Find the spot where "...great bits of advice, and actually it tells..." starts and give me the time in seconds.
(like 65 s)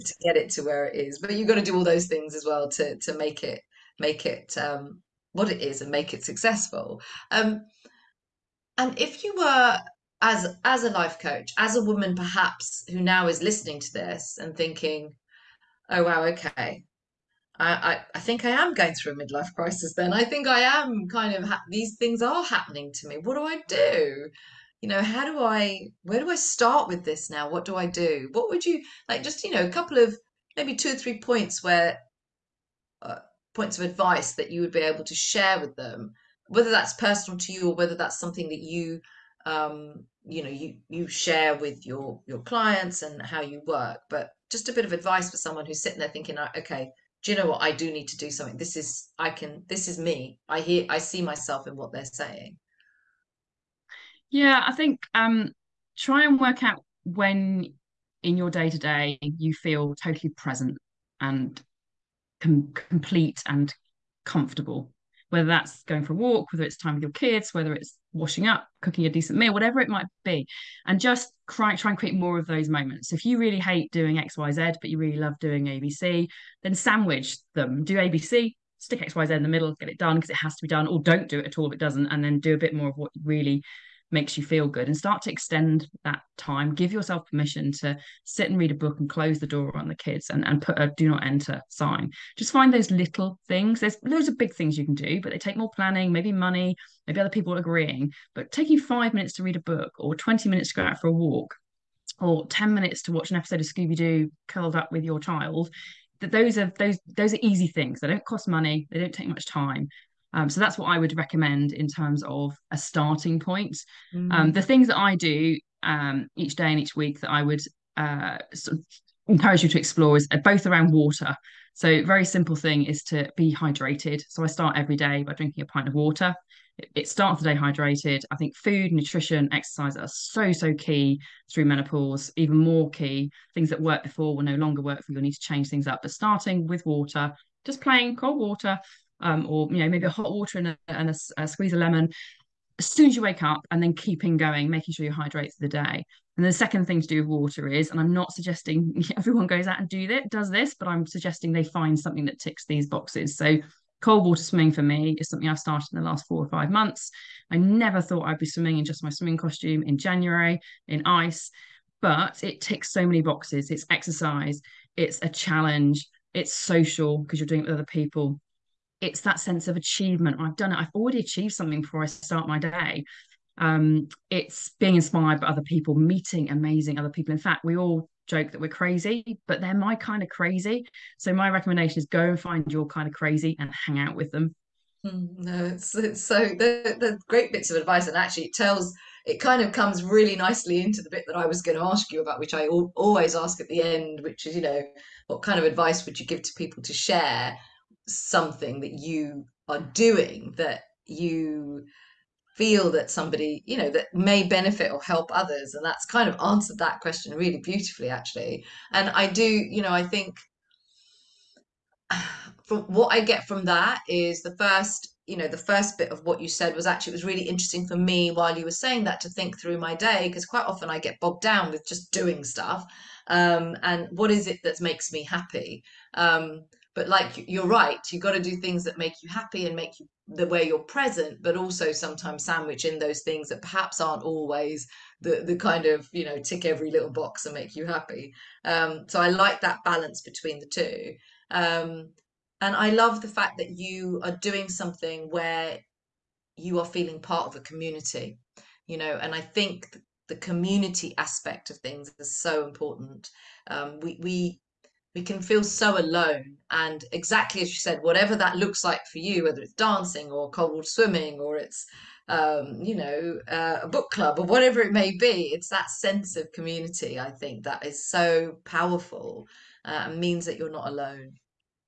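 187 s.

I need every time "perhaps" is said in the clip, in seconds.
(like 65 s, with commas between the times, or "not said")
12 s, 233 s.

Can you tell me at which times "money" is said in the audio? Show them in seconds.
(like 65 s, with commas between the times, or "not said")
96 s, 108 s.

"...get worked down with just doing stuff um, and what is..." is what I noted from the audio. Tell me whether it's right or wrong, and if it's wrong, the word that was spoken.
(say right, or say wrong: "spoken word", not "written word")
wrong: "bogged", not "worked".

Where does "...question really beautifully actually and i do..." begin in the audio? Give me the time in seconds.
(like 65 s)
206 s.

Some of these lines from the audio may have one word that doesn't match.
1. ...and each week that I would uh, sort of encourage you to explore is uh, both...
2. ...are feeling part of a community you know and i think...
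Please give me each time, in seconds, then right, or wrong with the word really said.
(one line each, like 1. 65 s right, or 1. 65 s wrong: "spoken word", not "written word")
1. 116 s right
2. 246 s right.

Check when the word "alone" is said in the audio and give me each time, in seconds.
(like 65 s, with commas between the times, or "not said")
255 s, 270 s.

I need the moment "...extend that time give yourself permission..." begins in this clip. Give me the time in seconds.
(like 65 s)
85 s.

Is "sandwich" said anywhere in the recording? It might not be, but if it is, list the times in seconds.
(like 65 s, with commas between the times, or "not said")
76 s, 232 s.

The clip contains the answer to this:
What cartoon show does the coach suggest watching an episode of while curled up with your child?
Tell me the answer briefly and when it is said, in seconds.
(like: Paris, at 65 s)
Scooby-Doo, at 103 s.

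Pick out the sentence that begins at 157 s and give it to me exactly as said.
I never thought I'd be swimming in just my swimming costume in January in ice, but it ticks so many boxes.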